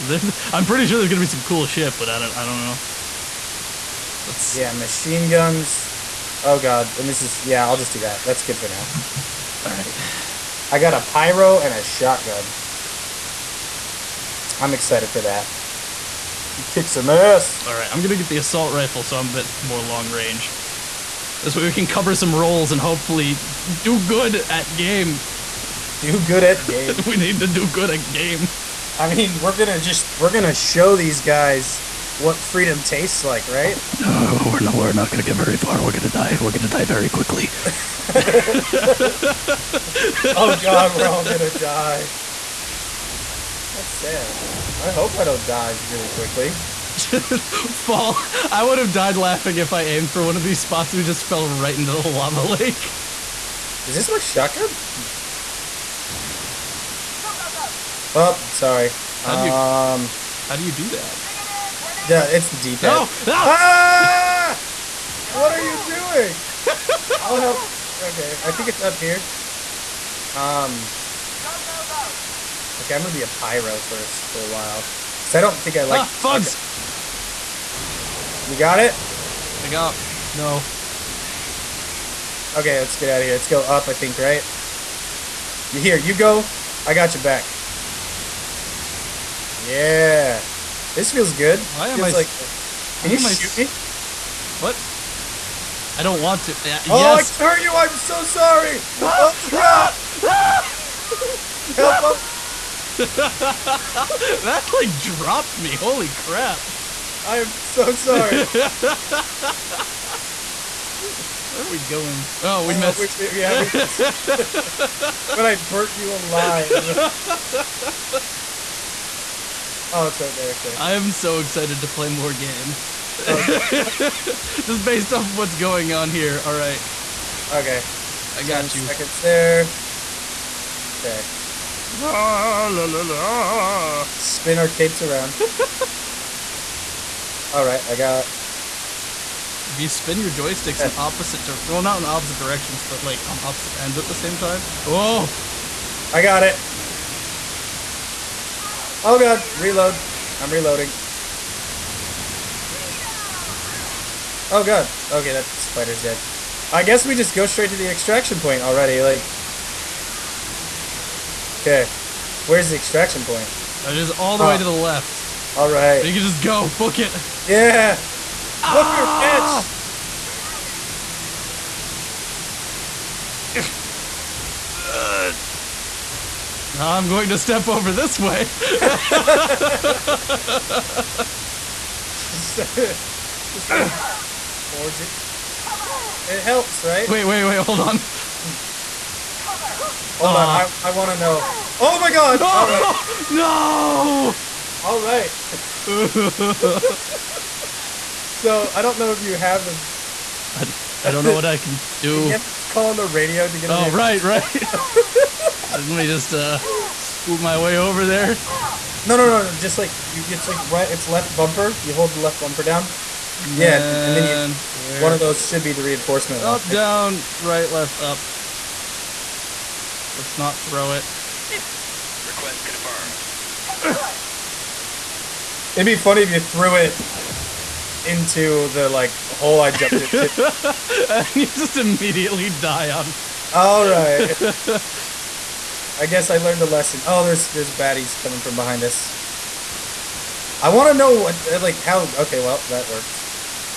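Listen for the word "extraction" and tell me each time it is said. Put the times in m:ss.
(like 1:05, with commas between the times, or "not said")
2:37, 2:42.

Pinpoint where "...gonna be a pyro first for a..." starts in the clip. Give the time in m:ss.
1:13.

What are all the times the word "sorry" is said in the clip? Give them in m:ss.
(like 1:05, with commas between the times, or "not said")
0:58, 1:38, 1:47.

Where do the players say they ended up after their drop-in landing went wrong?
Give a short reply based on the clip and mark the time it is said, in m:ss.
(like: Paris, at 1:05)
Lava lake, at 0:52.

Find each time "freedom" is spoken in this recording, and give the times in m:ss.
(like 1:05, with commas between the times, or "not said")
0:32.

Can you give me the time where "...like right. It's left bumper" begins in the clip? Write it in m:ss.
3:30.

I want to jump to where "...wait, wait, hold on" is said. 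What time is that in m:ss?
3:07.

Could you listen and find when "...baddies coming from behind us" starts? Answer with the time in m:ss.
3:57.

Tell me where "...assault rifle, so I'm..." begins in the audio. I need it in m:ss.
0:18.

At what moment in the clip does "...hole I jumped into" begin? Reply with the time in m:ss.
3:49.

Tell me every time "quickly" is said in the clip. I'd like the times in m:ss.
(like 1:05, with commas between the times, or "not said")
0:37, 0:46.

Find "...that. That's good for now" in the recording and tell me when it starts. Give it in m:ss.
0:07.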